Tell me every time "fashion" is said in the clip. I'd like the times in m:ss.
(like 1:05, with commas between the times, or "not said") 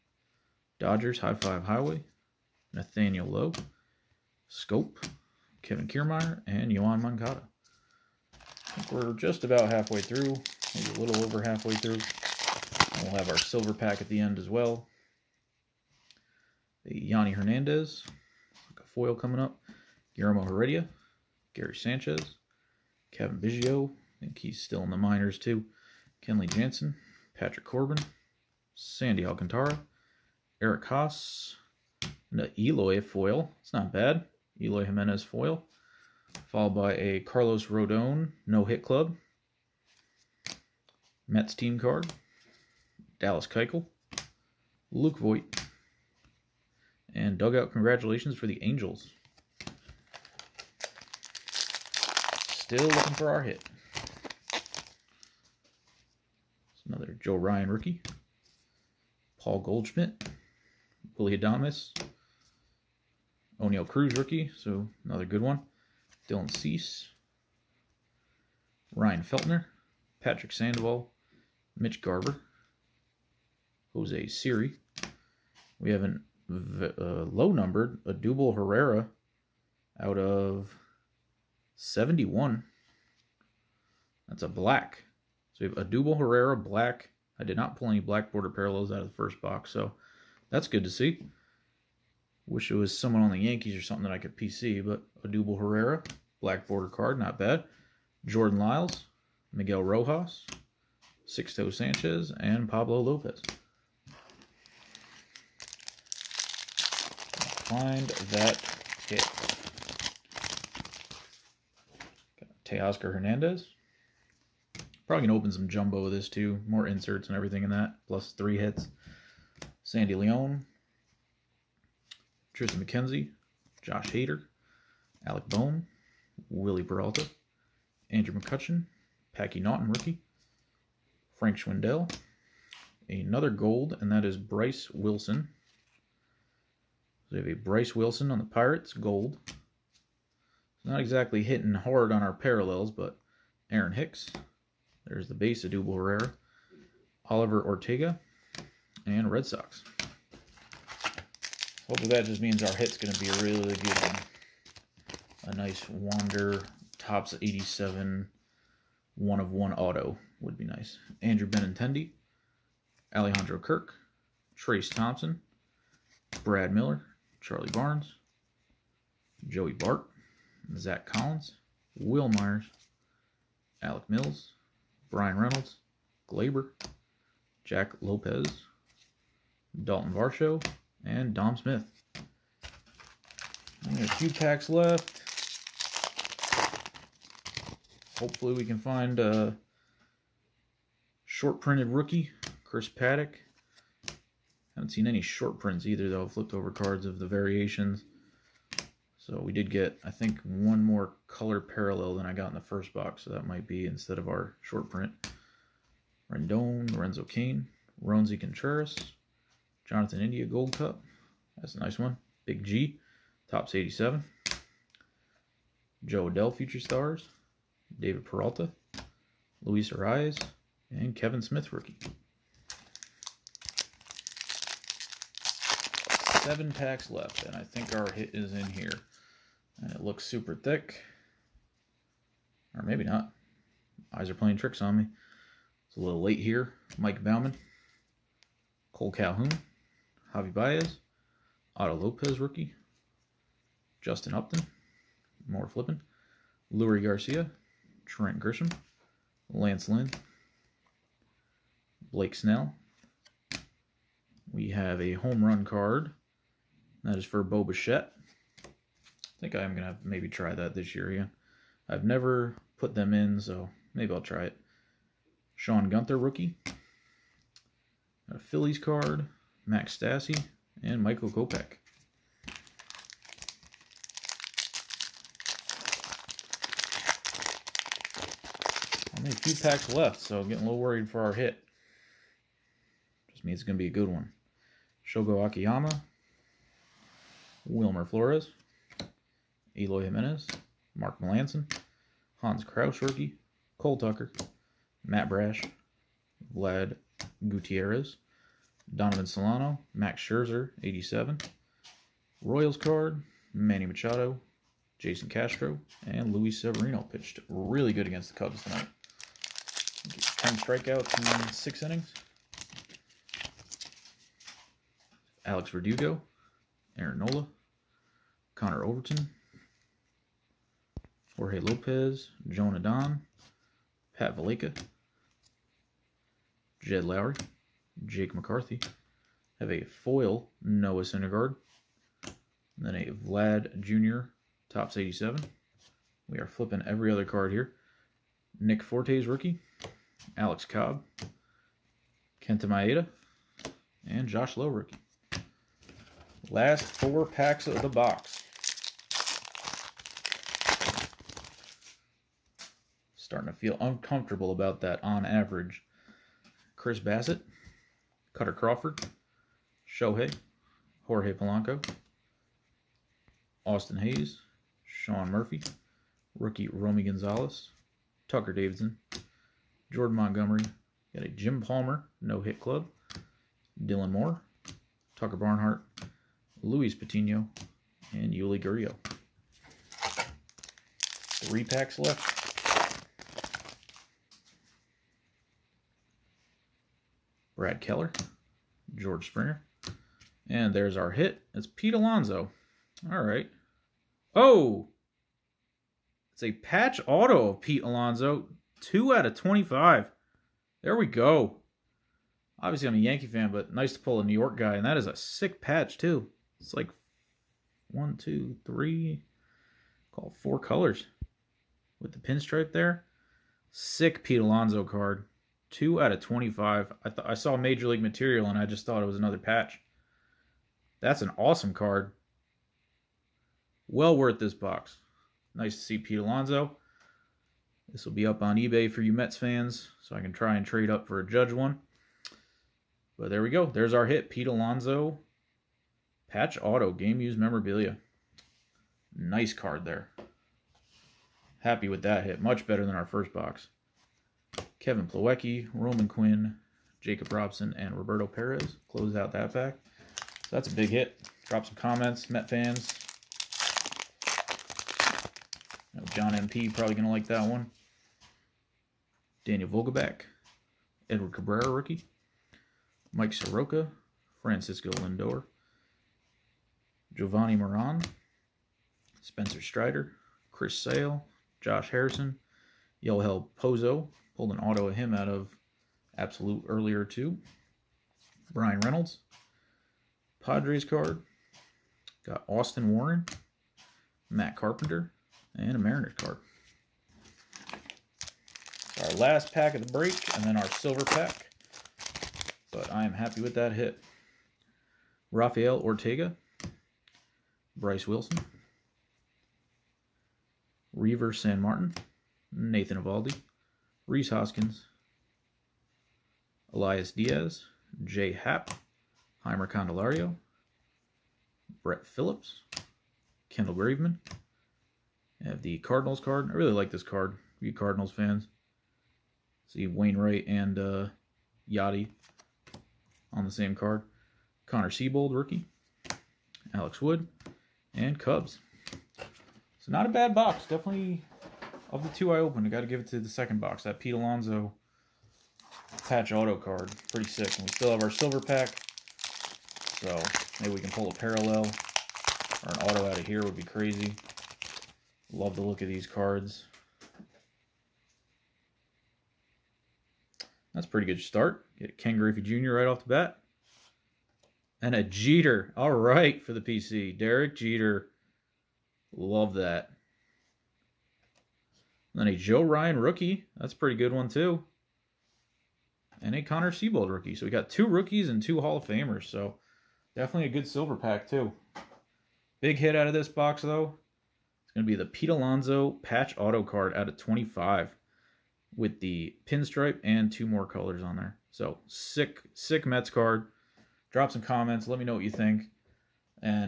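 not said.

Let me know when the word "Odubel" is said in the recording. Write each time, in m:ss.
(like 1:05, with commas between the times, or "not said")
1:18, 1:25, 1:35.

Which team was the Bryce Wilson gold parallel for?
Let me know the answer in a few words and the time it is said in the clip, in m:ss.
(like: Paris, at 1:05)
Pirates, at 2:18.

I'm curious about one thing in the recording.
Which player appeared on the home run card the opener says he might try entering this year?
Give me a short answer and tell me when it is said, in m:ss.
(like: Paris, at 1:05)
Bo Bichette, at 4:17.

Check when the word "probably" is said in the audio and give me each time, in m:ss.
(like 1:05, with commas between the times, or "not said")
1:55, 7:36.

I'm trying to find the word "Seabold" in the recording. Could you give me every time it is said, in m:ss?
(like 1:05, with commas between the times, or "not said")
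8:44, 9:26.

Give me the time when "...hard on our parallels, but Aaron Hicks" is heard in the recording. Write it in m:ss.
2:21.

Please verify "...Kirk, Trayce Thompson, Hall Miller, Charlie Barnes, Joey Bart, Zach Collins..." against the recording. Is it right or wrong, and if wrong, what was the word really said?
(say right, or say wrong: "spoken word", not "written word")
wrong: "Brad", not "Hall".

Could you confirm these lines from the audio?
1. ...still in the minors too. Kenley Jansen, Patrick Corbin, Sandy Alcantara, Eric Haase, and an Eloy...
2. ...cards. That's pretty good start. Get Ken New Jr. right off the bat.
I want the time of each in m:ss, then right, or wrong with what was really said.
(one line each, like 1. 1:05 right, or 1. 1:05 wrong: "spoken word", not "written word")
1. 0:24 right
2. 9:06 wrong: "Griffey", not "New".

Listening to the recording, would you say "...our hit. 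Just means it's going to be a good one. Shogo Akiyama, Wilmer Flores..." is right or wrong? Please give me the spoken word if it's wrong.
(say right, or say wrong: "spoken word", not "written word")
right.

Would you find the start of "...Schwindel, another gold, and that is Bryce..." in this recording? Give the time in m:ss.
2:11.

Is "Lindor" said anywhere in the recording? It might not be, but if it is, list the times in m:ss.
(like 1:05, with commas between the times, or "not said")
7:44.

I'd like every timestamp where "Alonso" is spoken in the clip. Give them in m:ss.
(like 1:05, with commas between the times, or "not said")
6:31, 6:37, 6:54, 7:06, 7:14, 8:54, 9:35.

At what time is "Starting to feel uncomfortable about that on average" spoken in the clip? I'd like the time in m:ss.
5:53.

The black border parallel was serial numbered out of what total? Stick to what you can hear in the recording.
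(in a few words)
71.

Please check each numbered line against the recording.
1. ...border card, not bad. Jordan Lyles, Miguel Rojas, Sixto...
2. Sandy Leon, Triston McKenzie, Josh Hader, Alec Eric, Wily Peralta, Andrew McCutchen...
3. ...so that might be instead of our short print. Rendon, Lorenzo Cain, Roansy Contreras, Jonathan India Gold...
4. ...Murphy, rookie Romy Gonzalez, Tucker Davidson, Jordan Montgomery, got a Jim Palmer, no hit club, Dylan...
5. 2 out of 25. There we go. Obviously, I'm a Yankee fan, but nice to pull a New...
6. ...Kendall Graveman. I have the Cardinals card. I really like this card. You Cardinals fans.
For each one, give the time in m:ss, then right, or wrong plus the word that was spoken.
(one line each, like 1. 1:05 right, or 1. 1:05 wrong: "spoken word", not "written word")
1. 1:36 right
2. 1:59 wrong: "Bohm", not "Eric"
3. 3:23 right
4. 6:05 right
5. 6:38 right
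6. 8:33 right.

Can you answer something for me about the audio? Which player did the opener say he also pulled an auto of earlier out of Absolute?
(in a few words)
Yoel Pozo.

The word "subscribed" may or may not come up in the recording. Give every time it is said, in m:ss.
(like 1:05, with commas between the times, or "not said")
not said.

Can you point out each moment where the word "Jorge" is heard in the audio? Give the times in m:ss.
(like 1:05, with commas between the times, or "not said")
5:21, 6:01.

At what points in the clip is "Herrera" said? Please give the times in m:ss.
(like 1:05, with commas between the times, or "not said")
1:18, 1:26, 1:35, 2:25.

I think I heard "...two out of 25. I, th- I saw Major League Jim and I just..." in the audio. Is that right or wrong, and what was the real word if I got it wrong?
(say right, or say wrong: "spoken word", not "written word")
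wrong: "Material", not "Jim".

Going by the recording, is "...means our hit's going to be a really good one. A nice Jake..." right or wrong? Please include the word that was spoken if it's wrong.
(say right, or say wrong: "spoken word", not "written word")
wrong: "Wander", not "Jake".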